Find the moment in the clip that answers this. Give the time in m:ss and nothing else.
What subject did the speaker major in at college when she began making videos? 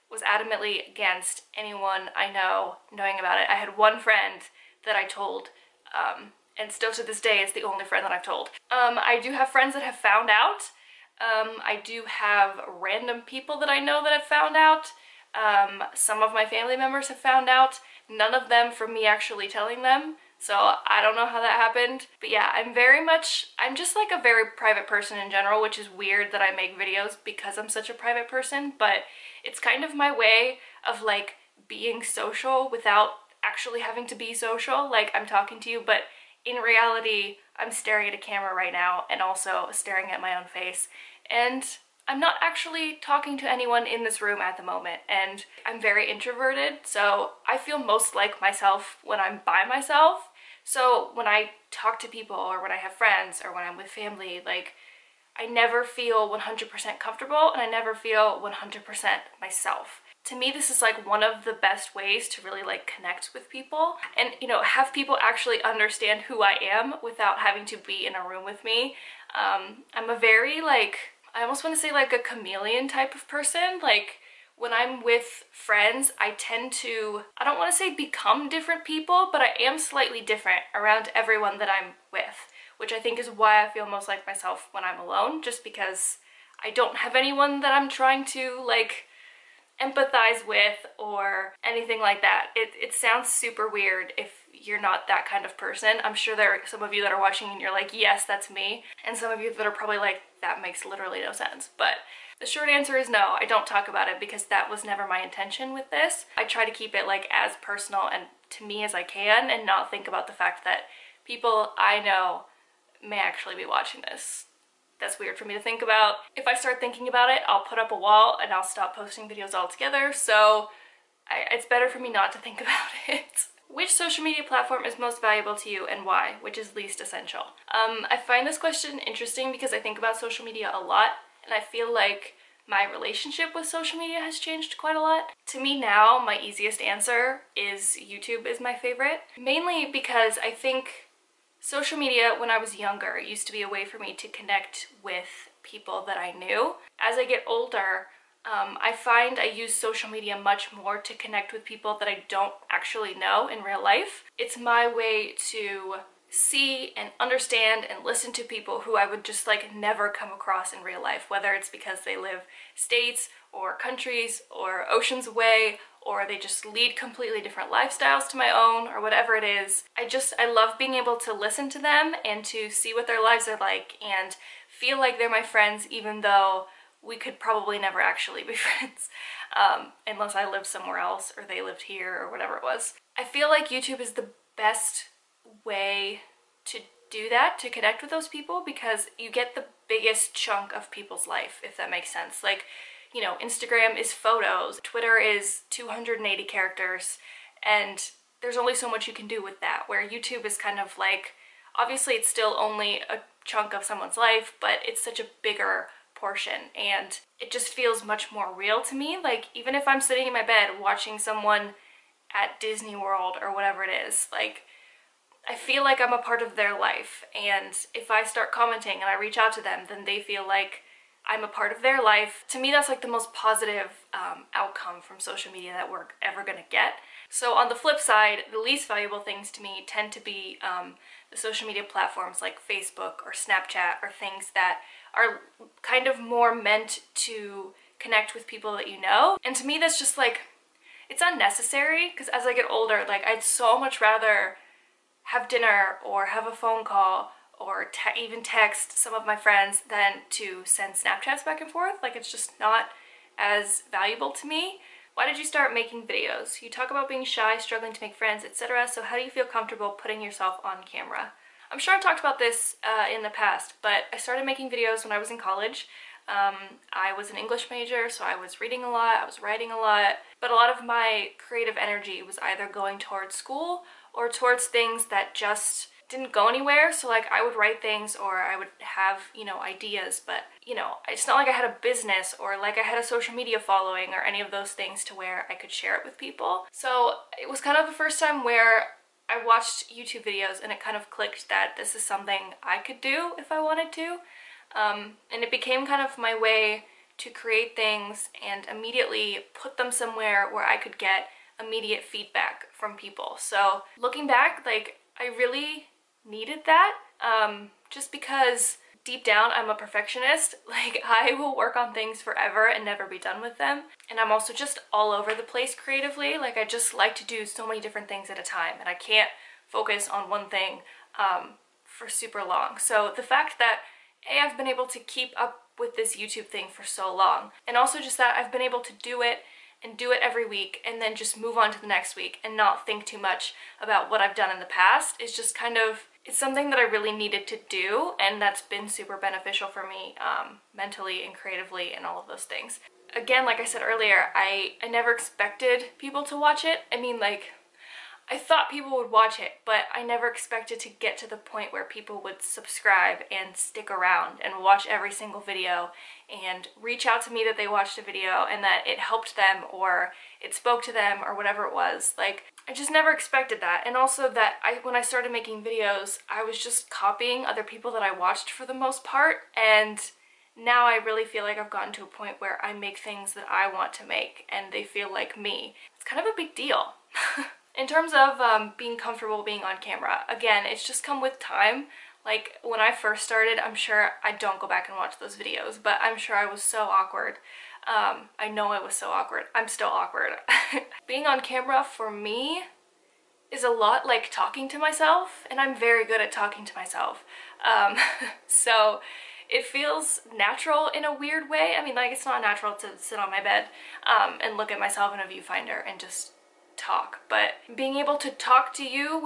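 4:27.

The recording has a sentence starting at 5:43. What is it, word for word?
Again, like I said earlier, I, I never expected people to watch it.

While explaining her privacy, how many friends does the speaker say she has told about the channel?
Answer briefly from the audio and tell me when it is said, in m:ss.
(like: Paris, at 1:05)
1, at 0:03.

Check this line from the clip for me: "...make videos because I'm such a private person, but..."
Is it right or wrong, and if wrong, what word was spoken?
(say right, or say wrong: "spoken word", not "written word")
right.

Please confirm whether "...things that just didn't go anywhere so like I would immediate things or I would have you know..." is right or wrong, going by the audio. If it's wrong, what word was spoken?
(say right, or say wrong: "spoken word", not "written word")
wrong: "write", not "immediate".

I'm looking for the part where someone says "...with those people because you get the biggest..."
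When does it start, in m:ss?
3:08.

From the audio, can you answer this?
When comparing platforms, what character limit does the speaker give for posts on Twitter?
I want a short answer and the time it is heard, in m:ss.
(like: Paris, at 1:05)
280, at 3:15.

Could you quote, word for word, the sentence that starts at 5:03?
So looking back, like I really needed that um, just because deep down, I'm a perfectionist.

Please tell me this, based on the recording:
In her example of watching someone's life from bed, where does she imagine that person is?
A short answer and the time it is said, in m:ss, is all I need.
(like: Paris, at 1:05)
Disney World, at 3:32.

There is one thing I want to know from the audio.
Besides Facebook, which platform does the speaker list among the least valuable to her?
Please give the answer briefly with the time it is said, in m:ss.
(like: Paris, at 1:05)
Snapchat, at 3:53.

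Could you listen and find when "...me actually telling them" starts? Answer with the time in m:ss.
0:18.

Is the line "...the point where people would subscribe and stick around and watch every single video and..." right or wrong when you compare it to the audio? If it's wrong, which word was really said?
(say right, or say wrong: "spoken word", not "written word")
right.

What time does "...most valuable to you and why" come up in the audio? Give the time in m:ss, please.
2:04.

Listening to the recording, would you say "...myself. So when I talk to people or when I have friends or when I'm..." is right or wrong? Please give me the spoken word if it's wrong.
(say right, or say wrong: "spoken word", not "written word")
right.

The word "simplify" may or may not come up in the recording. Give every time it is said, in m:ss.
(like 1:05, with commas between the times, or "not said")
not said.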